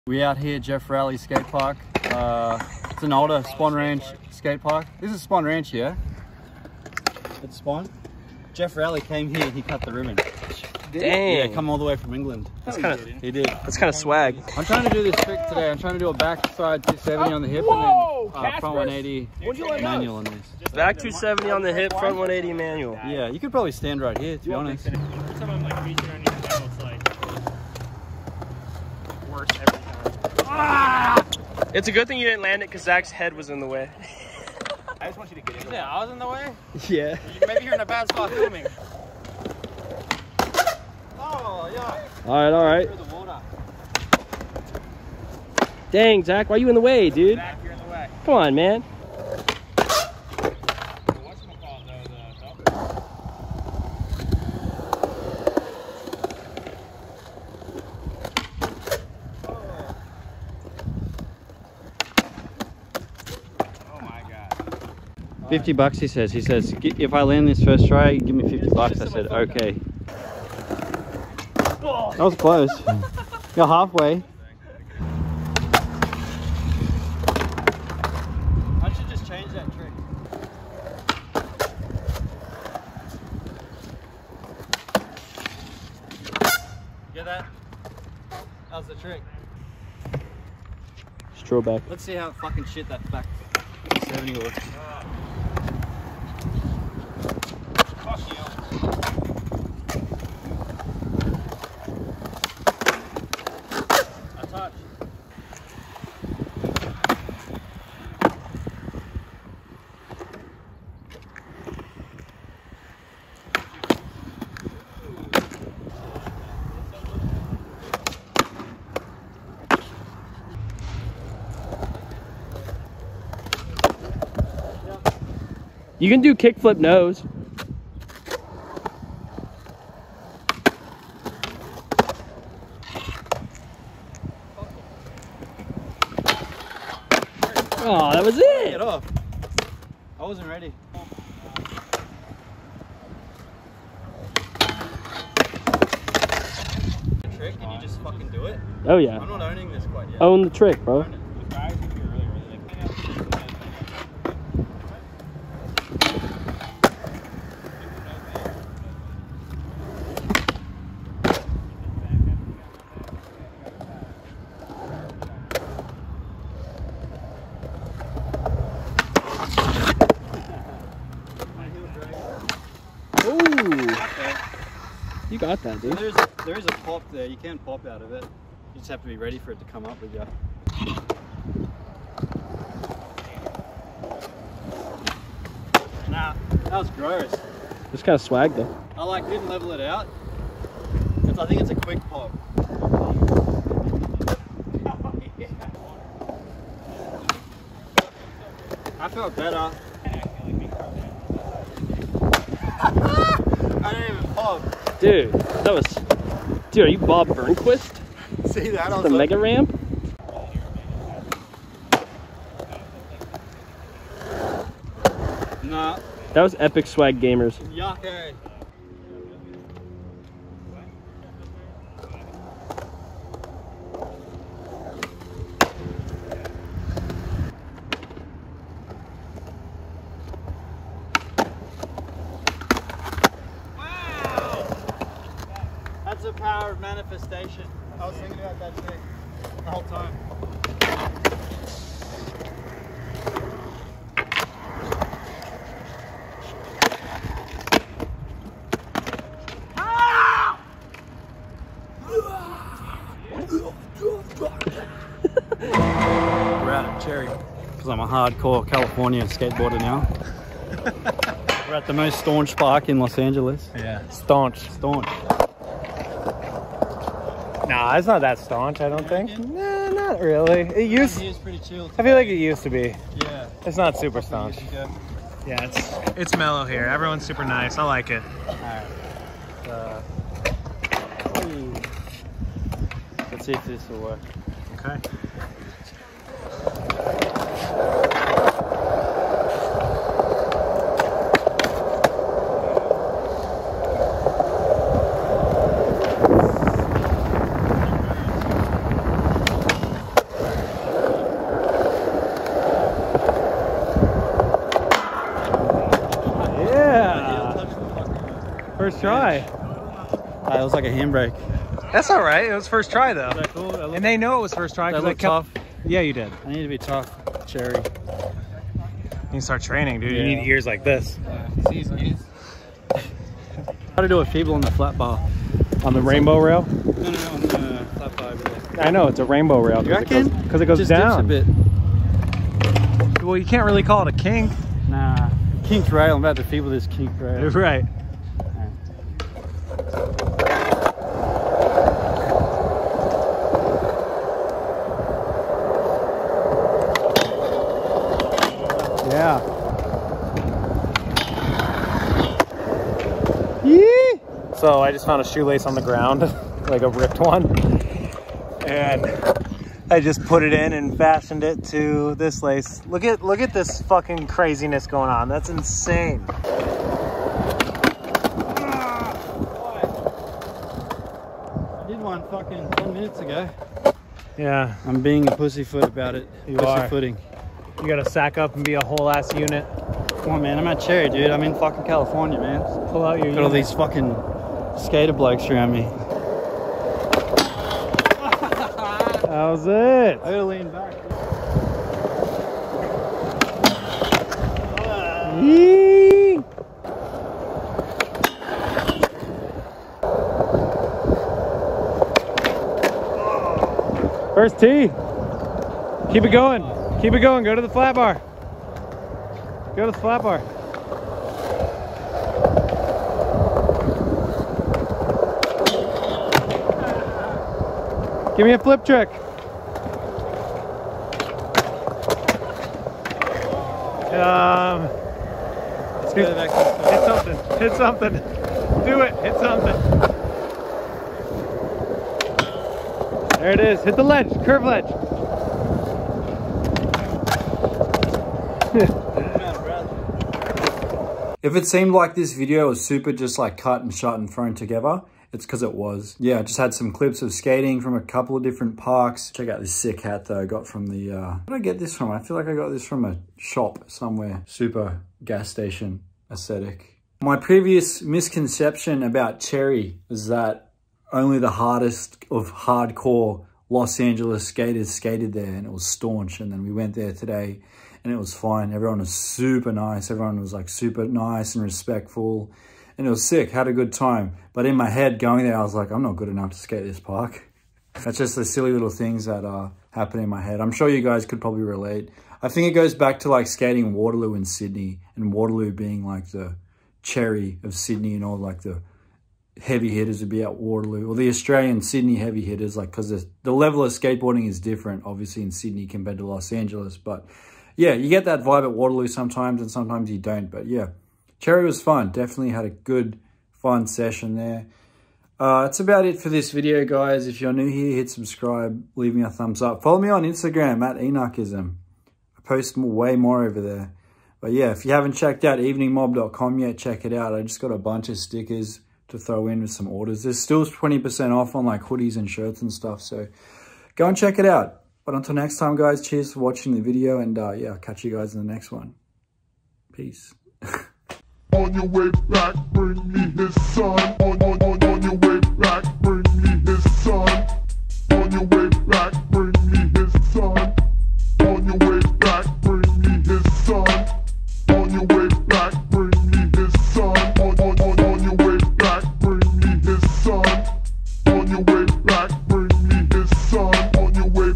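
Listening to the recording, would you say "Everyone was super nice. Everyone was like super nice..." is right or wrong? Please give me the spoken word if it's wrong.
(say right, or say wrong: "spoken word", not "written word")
right.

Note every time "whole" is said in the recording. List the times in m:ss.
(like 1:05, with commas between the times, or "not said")
3:59, 6:18.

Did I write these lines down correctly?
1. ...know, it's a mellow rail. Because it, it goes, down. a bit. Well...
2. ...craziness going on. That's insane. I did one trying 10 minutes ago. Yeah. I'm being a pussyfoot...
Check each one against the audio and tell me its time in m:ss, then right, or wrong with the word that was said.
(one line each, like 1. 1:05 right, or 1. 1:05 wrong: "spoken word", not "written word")
1. 5:28 wrong: "rainbow", not "mellow"
2. 6:04 wrong: "fucking", not "trying".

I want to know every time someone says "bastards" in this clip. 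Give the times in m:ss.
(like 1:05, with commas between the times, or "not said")
not said.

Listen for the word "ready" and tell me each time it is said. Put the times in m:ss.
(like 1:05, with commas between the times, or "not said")
2:20, 2:59.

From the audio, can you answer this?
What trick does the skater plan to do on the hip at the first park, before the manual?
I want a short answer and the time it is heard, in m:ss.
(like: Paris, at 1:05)
Backside 270, at 0:16.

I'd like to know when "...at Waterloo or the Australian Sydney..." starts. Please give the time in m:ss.
8:10.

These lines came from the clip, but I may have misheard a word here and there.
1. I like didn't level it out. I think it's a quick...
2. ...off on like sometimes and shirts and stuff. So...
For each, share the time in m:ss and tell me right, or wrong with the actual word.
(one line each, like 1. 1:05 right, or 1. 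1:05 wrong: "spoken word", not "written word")
1. 3:08 right
2. 8:41 wrong: "hoodies", not "sometimes".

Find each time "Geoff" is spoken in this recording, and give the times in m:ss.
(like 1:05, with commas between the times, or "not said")
0:00, 0:08.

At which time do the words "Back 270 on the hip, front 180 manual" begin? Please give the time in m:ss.
0:20.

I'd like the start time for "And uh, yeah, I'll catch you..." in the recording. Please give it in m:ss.
8:47.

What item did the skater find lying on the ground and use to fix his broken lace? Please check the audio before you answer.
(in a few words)
A shoelace.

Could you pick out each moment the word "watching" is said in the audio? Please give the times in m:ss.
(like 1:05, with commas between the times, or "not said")
8:46.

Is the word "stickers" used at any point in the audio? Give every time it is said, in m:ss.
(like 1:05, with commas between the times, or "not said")
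8:38.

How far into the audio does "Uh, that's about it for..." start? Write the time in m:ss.
8:25.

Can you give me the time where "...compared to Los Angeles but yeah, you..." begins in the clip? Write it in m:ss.
8:15.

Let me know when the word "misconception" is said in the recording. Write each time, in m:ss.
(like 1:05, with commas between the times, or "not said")
7:38.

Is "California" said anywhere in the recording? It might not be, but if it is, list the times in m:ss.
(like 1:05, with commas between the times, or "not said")
4:18, 6:21.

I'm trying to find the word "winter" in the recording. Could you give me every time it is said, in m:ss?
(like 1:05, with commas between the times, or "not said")
not said.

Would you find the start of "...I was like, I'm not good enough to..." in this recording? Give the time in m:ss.
7:55.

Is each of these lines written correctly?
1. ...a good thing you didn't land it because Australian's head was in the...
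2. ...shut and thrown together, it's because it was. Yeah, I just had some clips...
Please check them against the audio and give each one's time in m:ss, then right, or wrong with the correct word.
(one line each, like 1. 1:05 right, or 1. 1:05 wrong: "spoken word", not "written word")
1. 0:31 wrong: "Zach", not "Australian"
2. 7:23 right.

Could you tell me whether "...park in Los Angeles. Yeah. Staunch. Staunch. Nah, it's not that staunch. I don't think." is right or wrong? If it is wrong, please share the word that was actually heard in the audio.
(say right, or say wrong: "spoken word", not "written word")
right.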